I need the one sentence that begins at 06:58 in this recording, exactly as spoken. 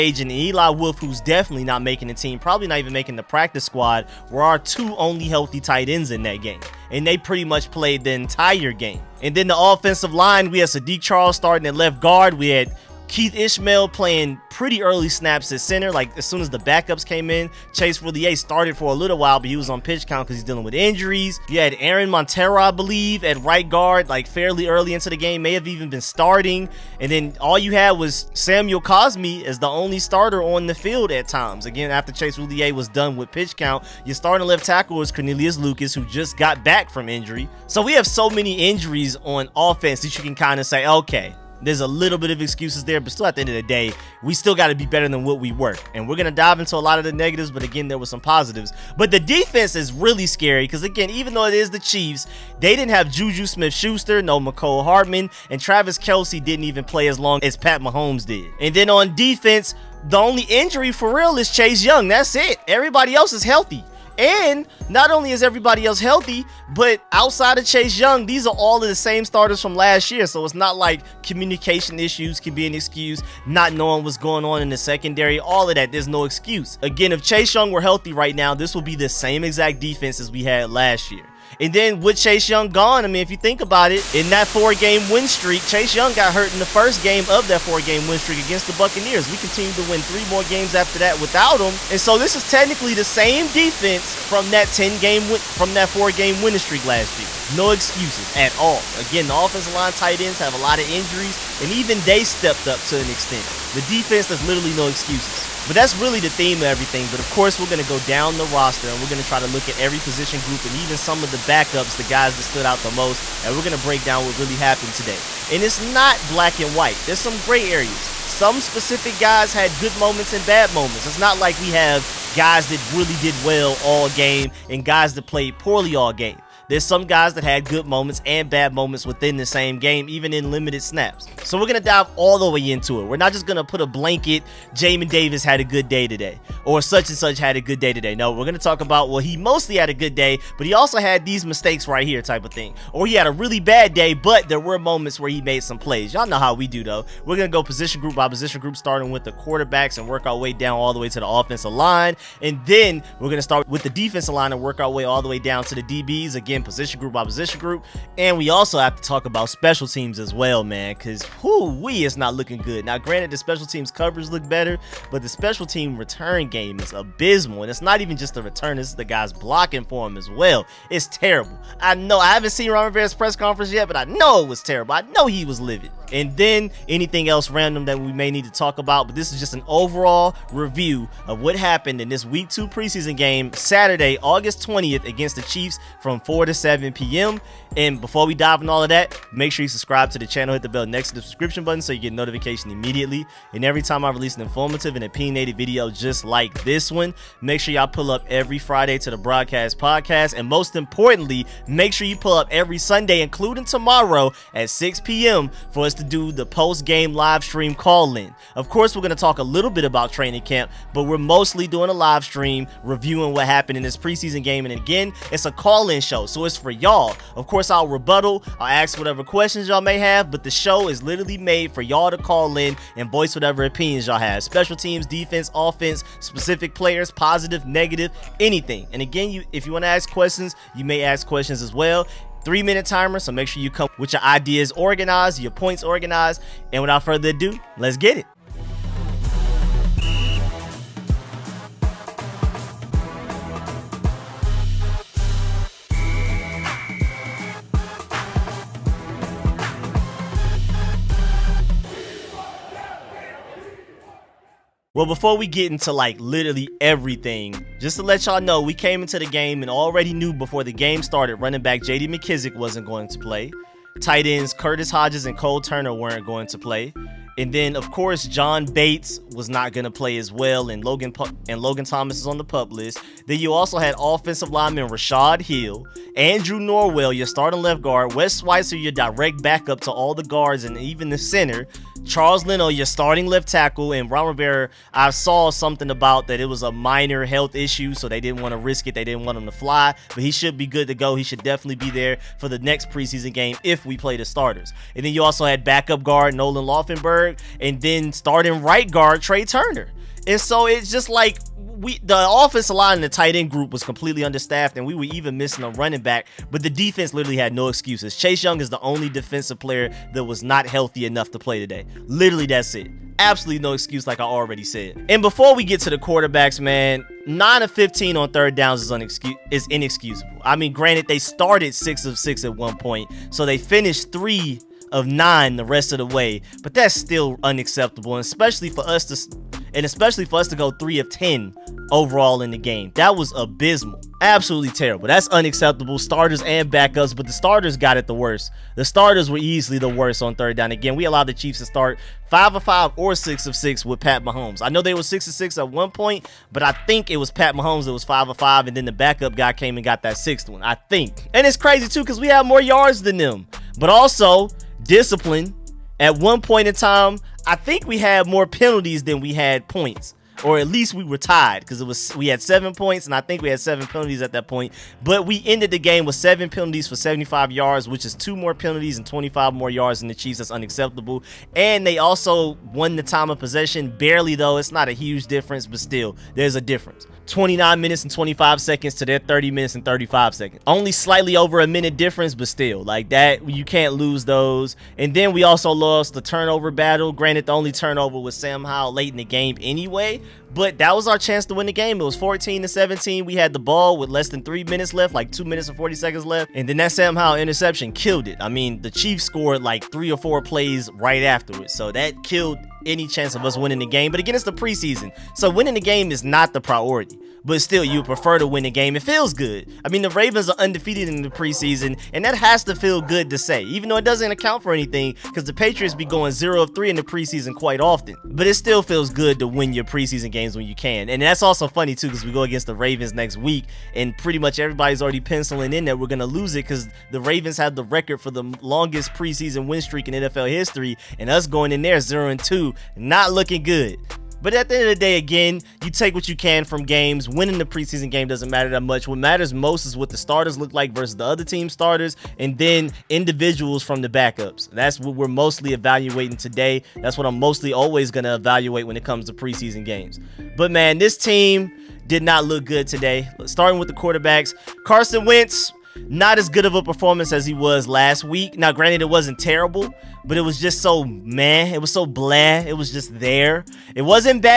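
But it still feels good to win your preseason game games when you can.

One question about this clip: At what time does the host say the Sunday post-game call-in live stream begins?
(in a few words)
6 p.m.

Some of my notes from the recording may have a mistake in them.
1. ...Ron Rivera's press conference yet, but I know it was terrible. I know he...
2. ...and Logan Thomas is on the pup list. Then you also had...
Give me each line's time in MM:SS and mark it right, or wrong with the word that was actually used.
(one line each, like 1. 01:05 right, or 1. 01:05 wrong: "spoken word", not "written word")
1. 02:52 right
2. 04:31 right.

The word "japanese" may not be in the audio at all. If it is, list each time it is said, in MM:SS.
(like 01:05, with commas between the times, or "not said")
not said.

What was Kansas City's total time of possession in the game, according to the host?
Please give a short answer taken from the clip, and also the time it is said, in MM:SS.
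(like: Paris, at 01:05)
30 minutes 35 seconds, at 06:19.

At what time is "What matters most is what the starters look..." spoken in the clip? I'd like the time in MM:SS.
07:19.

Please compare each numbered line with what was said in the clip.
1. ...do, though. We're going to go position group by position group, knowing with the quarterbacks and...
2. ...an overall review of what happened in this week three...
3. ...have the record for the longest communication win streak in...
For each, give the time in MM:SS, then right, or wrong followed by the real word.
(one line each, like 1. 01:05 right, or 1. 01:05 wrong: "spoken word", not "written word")
1. 02:26 wrong: "starting", not "knowing"
2. 02:59 wrong: "two", not "three"
3. 07:07 wrong: "preseason", not "communication".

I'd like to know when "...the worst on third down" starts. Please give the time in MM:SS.
05:39.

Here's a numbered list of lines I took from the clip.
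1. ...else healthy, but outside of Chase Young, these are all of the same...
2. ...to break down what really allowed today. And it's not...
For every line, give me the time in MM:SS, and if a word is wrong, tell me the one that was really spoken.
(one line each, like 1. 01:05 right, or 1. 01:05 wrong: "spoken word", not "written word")
1. 01:05 right
2. 01:53 wrong: "happened", not "allowed".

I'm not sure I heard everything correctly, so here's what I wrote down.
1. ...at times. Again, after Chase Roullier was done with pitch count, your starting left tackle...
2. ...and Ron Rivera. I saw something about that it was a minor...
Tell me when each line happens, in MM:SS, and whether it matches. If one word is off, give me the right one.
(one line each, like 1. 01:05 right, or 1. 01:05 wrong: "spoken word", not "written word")
1. 00:31 right
2. 04:43 right.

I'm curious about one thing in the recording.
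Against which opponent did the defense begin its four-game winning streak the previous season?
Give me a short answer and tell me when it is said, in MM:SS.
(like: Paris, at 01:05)
Buccaneers, at 01:28.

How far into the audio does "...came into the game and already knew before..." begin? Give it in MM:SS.
04:18.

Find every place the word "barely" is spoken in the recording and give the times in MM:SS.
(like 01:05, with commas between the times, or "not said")
06:13.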